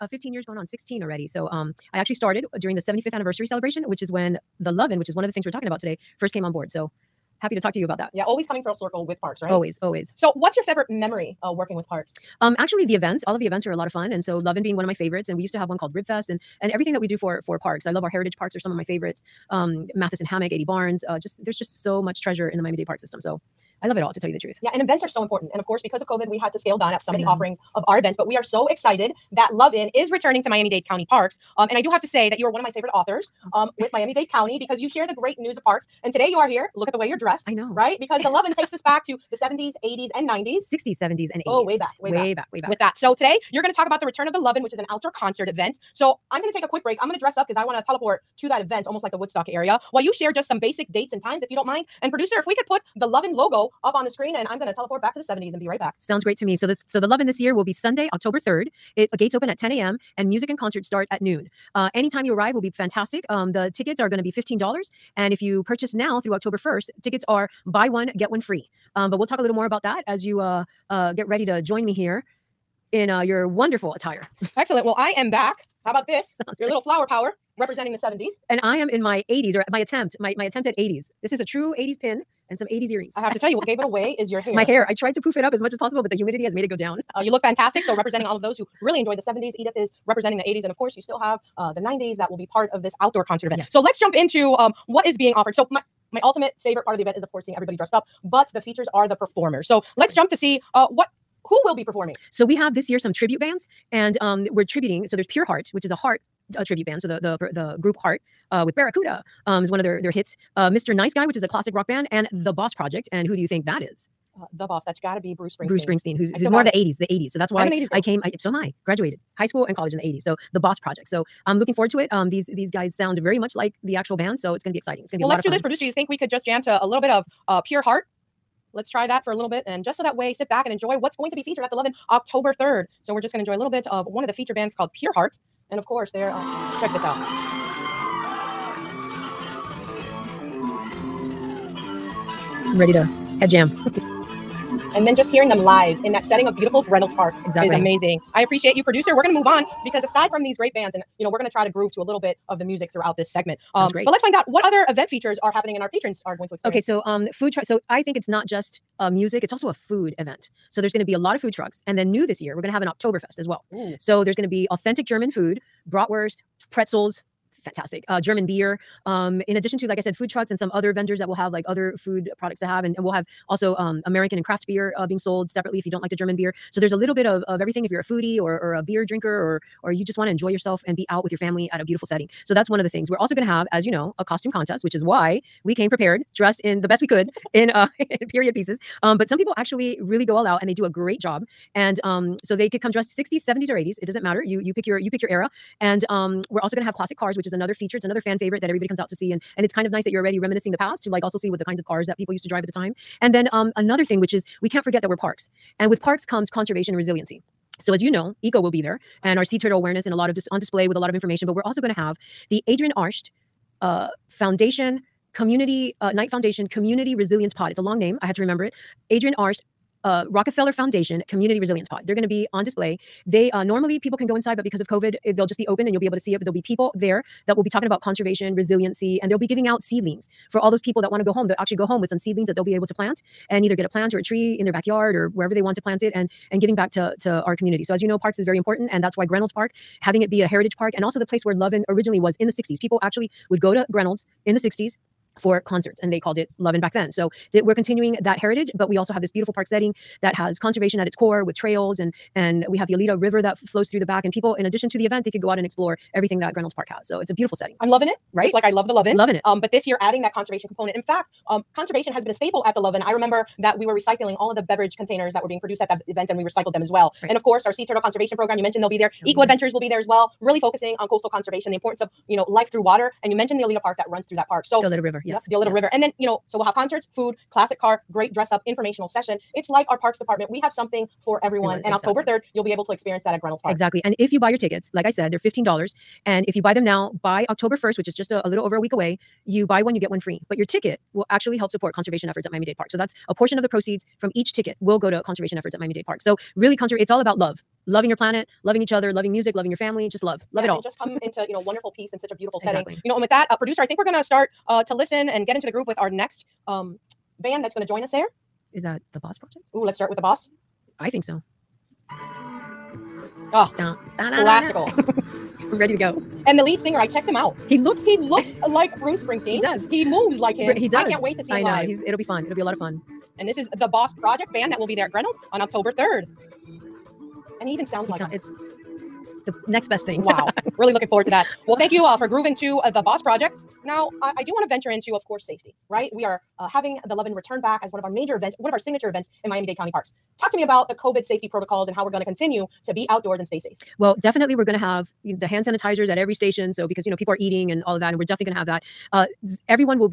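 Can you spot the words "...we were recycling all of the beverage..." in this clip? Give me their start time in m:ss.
4:23.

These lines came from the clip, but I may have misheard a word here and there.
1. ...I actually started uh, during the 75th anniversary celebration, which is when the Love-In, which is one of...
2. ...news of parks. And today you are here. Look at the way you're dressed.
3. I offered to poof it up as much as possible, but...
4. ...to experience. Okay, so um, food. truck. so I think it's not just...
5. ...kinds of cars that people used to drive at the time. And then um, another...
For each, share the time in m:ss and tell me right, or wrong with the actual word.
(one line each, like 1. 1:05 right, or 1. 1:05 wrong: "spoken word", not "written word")
1. 0:01 right
2. 0:35 right
3. 1:24 wrong: "tried", not "offered"
4. 2:36 right
5. 3:21 right.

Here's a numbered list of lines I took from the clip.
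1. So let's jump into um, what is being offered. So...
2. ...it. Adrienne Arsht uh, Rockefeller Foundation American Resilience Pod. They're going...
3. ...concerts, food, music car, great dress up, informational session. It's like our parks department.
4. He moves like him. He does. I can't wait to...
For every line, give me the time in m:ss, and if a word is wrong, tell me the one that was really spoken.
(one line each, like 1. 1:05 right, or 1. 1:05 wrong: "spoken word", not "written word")
1. 1:33 right
2. 3:38 wrong: "Community", not "American"
3. 4:36 wrong: "classic", not "music"
4. 5:19 right.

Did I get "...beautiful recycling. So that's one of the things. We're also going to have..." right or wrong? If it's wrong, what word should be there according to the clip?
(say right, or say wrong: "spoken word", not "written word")
wrong: "setting", not "recycling".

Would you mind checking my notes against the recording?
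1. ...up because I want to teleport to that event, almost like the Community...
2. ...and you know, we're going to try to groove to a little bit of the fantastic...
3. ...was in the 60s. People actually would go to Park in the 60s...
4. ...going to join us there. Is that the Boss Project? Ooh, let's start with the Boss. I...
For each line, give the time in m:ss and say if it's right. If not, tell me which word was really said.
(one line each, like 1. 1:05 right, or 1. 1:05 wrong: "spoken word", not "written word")
1. 0:47 wrong: "Woodstock", not "Community"
2. 2:30 wrong: "music", not "fantastic"
3. 4:02 wrong: "Greynolds", not "Park"
4. 5:07 right.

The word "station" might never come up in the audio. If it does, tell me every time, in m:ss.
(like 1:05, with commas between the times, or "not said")
5:46.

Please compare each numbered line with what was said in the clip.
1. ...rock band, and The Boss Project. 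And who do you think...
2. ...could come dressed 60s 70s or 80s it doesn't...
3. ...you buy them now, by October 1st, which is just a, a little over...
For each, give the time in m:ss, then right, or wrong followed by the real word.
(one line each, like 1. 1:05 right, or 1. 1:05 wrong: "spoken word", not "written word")
1. 1:51 right
2. 3:12 right
3. 4:46 right.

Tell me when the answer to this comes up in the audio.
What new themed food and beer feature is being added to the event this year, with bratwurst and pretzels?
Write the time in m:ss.
2:42.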